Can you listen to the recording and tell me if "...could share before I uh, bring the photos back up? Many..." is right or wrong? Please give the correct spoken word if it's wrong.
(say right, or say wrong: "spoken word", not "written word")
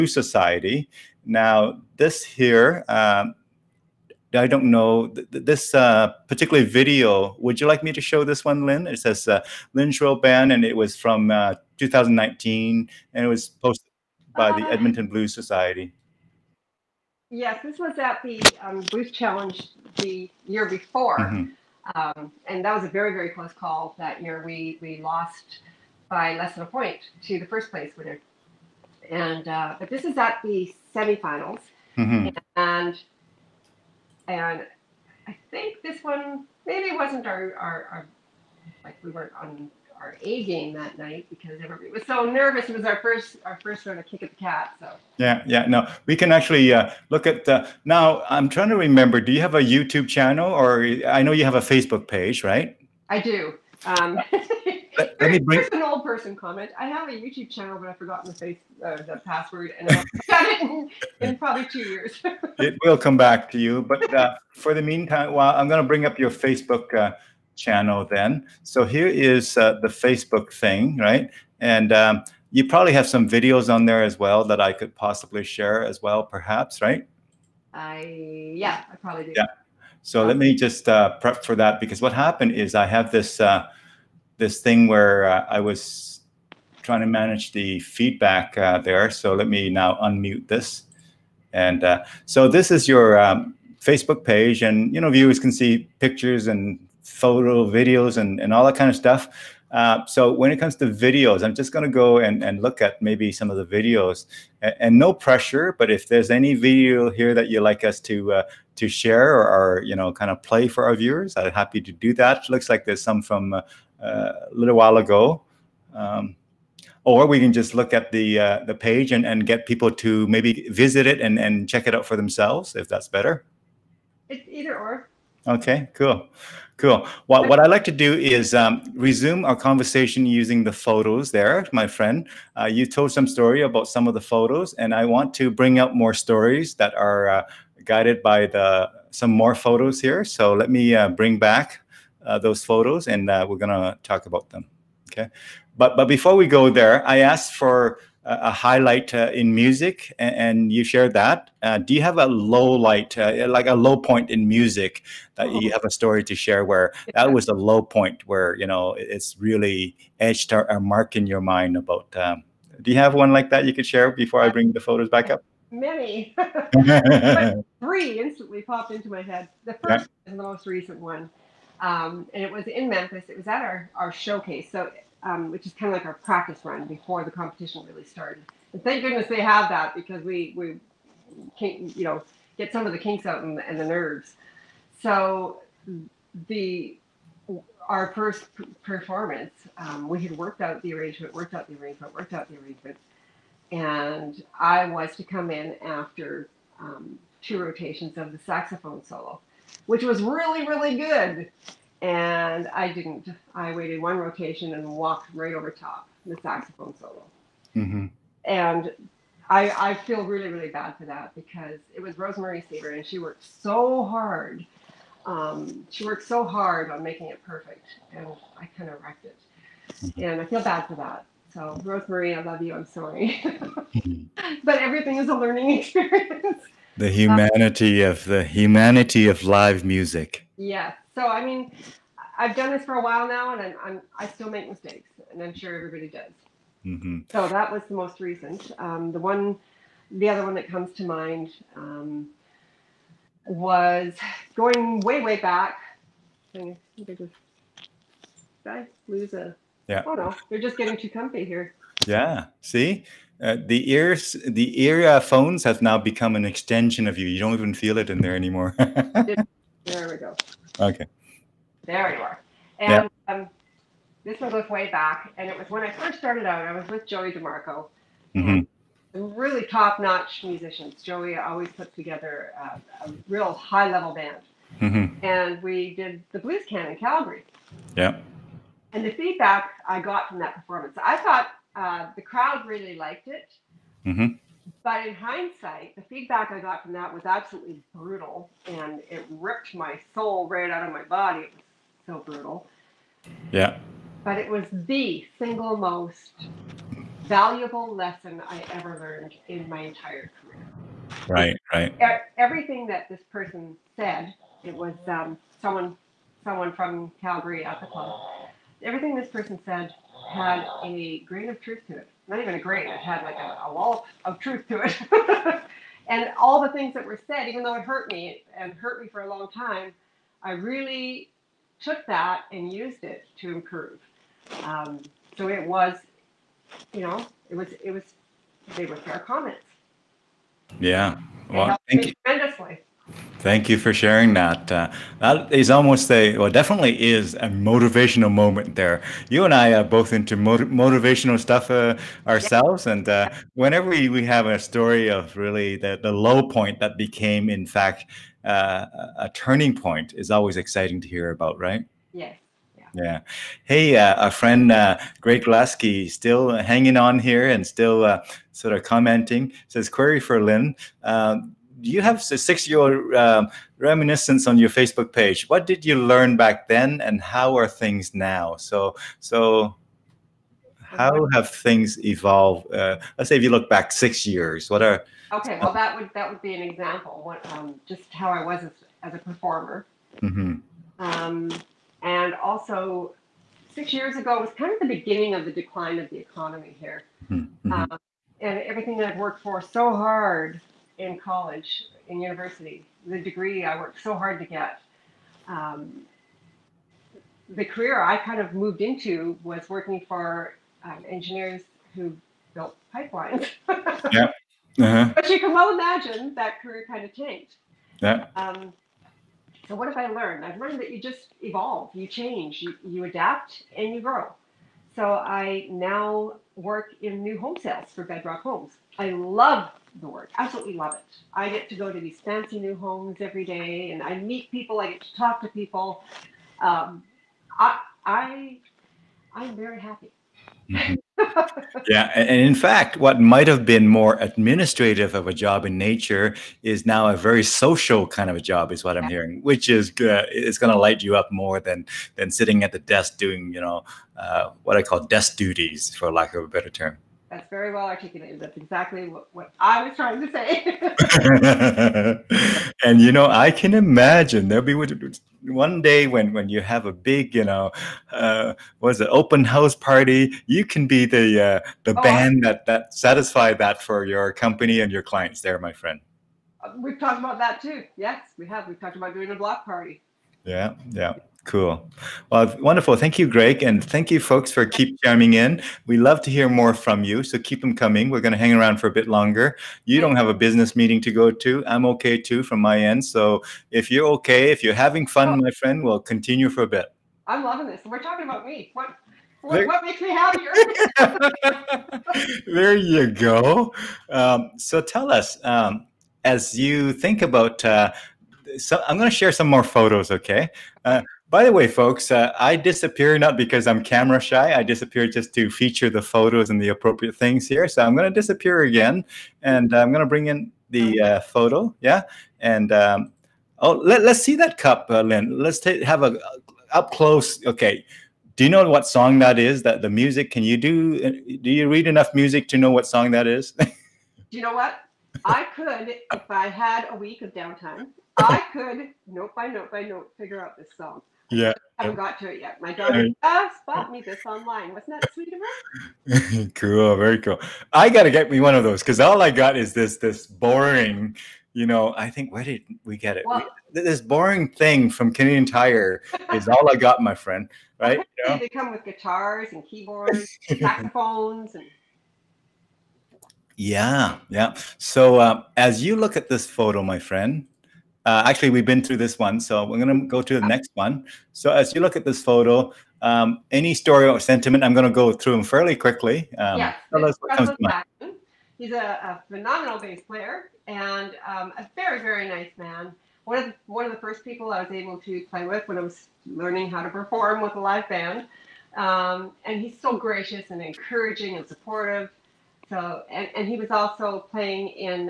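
right.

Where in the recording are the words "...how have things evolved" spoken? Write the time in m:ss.
6:10.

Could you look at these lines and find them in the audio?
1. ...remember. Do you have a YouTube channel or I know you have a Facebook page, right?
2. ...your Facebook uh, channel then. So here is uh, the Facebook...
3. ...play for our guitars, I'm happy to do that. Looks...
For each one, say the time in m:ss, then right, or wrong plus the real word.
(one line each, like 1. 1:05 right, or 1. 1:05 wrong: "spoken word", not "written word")
1. 0:48 right
2. 1:06 right
3. 1:50 wrong: "viewers", not "guitars".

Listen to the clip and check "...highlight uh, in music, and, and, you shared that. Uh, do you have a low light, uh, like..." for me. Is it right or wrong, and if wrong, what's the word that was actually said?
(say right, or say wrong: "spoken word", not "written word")
right.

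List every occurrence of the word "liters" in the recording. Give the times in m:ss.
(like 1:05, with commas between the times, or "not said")
not said.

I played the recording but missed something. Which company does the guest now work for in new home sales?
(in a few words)
Bedrock Homes.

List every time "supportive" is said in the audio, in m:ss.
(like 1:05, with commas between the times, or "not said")
9:41.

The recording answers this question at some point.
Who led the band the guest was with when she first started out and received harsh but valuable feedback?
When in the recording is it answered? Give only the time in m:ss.
4:27.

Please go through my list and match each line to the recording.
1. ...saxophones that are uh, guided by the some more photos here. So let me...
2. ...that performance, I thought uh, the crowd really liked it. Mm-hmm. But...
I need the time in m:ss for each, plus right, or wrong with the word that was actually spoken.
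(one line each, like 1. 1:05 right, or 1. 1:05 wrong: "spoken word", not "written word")
1. 2:16 wrong: "stories", not "saxophones"
2. 4:40 right.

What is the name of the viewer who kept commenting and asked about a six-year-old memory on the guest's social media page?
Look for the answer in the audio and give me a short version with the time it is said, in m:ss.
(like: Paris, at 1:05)
Greg Glasky, at 5:55.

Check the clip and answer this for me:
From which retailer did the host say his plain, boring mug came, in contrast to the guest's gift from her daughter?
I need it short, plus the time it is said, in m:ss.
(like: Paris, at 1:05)
Canadian Tire, at 9:05.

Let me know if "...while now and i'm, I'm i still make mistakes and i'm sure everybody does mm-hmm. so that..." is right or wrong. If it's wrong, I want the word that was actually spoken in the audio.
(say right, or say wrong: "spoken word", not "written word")
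right.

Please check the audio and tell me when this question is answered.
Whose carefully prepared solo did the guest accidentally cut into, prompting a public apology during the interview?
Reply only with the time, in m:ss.
3:32.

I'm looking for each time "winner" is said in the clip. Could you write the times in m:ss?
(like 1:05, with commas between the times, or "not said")
0:27.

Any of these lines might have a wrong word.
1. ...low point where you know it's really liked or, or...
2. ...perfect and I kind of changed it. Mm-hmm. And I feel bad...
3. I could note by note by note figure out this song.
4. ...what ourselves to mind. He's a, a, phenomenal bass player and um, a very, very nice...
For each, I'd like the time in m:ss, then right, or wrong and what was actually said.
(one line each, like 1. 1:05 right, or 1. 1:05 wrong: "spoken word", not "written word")
1. 2:37 wrong: "etched", not "liked"
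2. 3:37 wrong: "wrecked", not "changed"
3. 8:48 right
4. 9:27 wrong: "comes", not "ourselves".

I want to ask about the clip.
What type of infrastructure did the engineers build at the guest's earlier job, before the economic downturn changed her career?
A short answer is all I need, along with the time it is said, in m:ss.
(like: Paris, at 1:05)
Pipelines, at 6:42.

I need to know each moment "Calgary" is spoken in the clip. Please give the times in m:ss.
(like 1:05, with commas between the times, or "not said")
4:36, 5:07.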